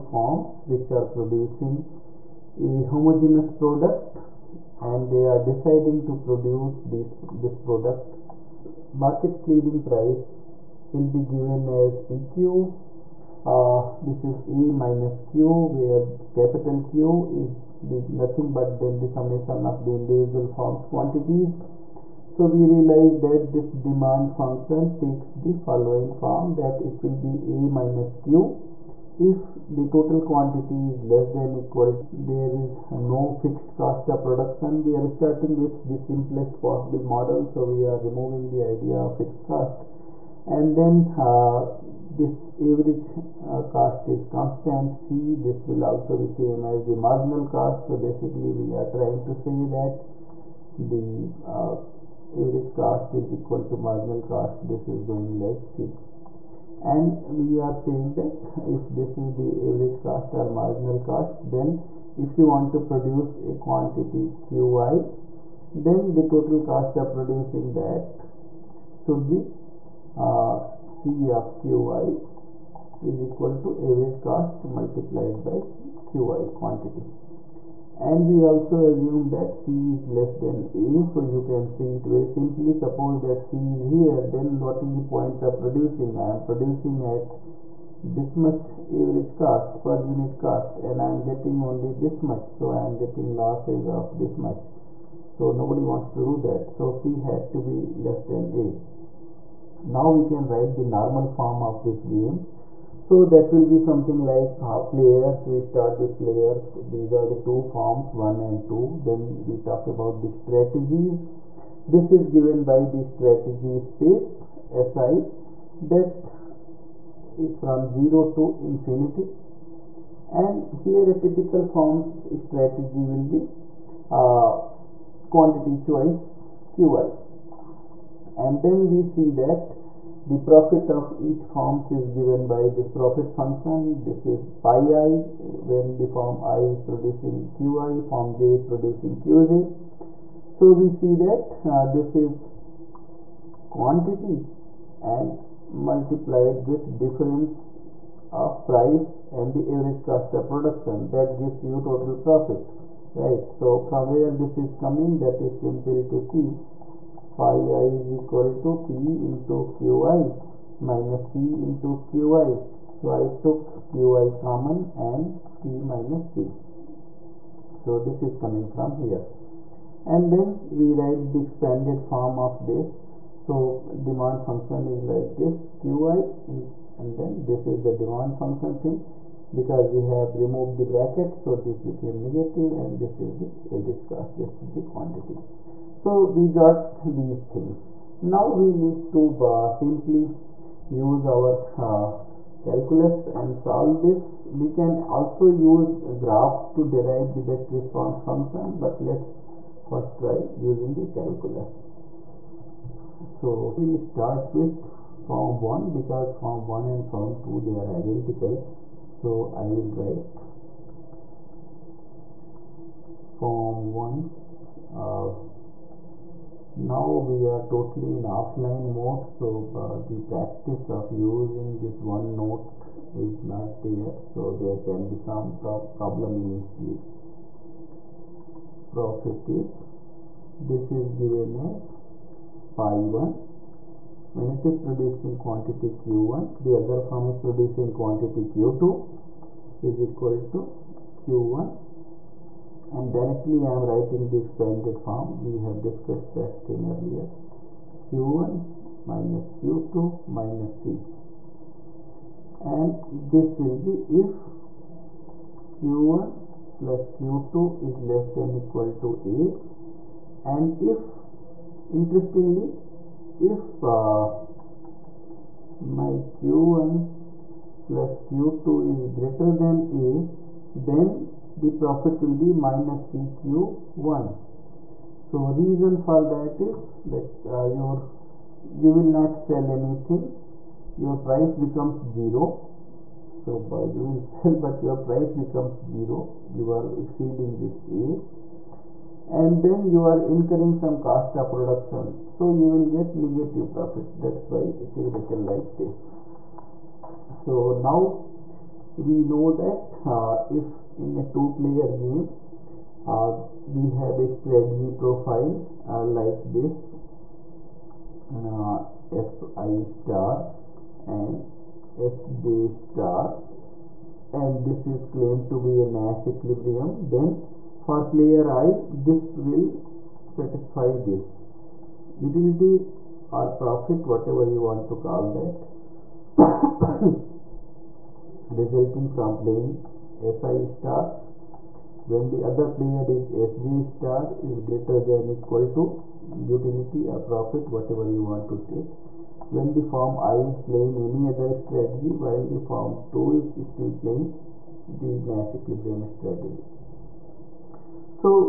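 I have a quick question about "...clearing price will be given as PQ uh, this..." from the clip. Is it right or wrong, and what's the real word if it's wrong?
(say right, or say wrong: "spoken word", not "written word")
right.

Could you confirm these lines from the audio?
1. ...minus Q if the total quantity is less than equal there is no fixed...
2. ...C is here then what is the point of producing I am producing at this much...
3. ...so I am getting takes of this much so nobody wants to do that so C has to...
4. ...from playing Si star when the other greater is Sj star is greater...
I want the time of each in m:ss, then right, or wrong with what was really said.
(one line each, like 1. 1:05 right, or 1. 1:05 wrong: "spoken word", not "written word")
1. 0:27 right
2. 1:23 right
3. 1:32 wrong: "losses", not "takes"
4. 5:29 wrong: "player", not "greater".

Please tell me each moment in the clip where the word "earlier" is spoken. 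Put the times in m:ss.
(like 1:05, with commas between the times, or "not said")
4:06.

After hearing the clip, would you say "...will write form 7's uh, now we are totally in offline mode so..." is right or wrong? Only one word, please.
wrong.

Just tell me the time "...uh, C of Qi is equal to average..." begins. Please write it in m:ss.
1:10.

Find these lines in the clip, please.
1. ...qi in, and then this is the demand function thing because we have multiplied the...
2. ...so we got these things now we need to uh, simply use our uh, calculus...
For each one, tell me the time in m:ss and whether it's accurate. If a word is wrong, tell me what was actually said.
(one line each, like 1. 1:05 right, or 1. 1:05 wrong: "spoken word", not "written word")
1. 2:55 wrong: "removed", not "multiplied"
2. 3:05 right.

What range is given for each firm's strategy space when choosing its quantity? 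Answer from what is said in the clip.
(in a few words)
0 to infinity.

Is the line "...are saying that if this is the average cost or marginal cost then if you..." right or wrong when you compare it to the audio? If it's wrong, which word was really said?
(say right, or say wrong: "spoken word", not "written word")
right.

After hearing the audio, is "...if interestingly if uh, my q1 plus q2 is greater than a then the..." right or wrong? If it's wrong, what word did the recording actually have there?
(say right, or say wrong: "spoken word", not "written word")
right.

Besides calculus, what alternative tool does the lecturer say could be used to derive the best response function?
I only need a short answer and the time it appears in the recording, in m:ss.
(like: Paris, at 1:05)
graphs, at 3:16.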